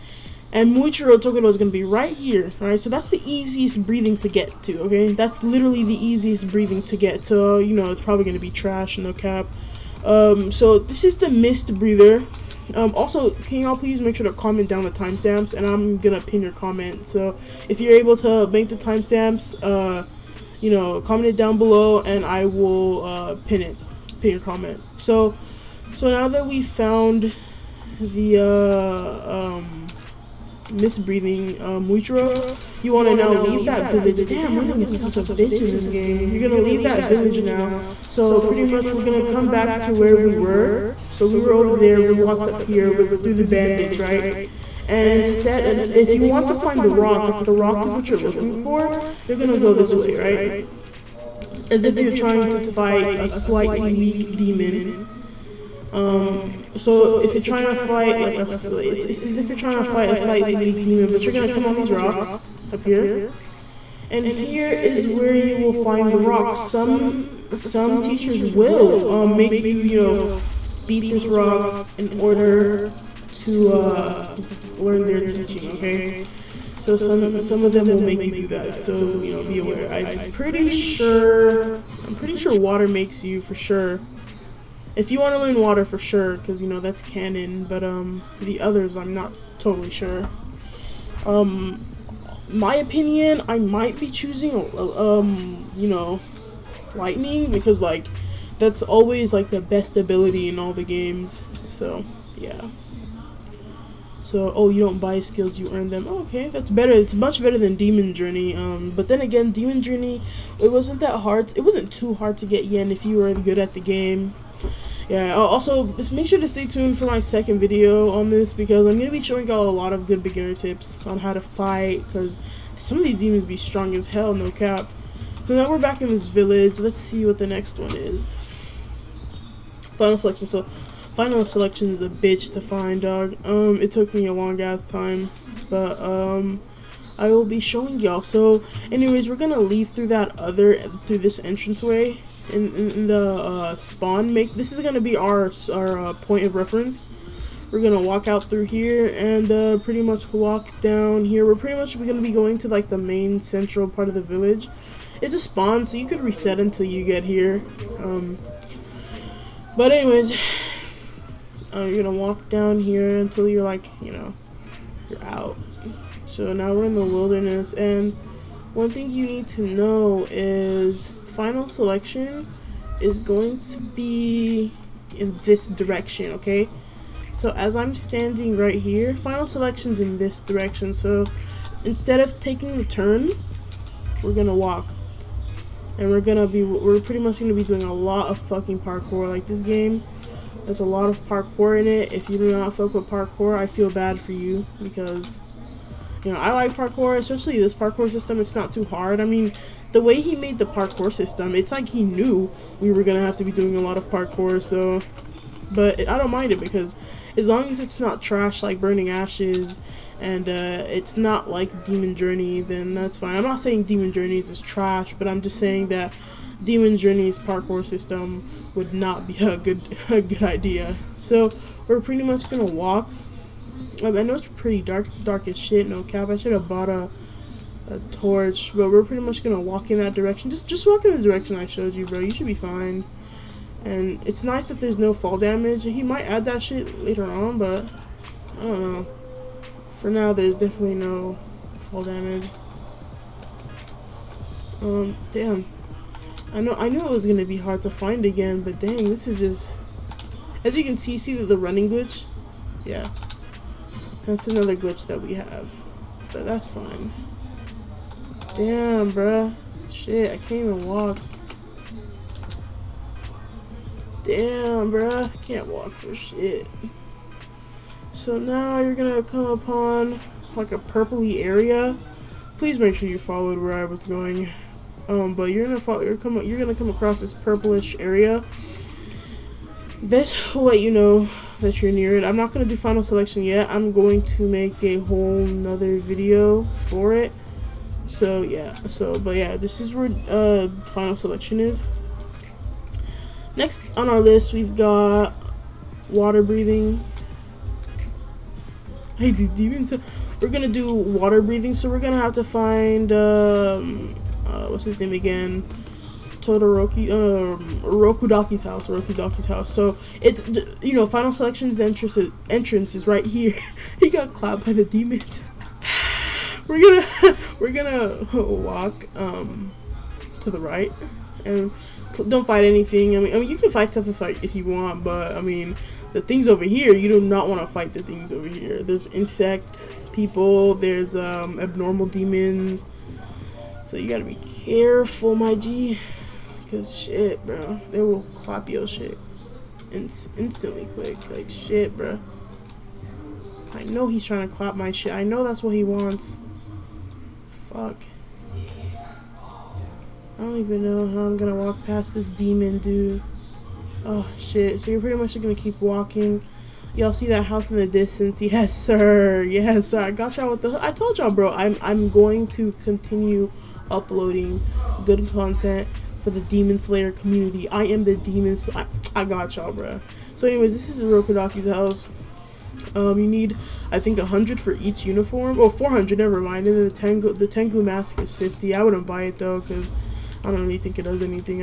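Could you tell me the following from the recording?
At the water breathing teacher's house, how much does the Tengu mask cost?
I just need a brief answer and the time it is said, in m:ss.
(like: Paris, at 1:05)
50, at 6:18.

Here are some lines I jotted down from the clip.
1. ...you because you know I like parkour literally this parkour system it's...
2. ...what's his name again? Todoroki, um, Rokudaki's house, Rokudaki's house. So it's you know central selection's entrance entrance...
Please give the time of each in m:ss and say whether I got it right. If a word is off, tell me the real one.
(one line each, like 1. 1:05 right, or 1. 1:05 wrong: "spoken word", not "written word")
1. 3:14 wrong: "especially", not "literally"
2. 5:04 wrong: "final", not "central".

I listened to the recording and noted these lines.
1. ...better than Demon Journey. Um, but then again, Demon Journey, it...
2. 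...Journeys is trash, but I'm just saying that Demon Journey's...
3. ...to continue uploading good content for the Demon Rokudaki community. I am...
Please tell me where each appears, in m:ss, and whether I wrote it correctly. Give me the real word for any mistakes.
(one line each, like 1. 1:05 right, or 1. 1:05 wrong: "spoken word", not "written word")
1. 1:47 right
2. 3:34 right
3. 6:02 wrong: "Slayer", not "Rokudaki".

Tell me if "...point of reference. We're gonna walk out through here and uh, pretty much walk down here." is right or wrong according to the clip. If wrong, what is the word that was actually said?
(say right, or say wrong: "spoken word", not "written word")
right.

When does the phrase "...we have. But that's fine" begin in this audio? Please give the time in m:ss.
4:15.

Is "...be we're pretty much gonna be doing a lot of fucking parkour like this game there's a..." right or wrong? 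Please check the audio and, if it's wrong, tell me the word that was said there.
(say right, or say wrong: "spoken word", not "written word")
right.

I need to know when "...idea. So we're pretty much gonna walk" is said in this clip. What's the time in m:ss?
3:40.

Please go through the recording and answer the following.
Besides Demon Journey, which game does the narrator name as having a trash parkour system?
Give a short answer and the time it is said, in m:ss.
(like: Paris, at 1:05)
Burning Ashes, at 3:28.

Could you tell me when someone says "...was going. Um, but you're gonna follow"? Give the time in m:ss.
4:33.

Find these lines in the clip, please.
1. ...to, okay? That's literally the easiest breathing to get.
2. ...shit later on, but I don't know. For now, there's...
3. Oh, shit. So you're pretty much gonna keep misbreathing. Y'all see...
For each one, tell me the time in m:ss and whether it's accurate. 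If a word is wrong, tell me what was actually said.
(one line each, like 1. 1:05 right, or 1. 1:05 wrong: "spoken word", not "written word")
1. 0:04 right
2. 3:56 right
3. 5:54 wrong: "walking", not "misbreathing".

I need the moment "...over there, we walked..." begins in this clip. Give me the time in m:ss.
0:41.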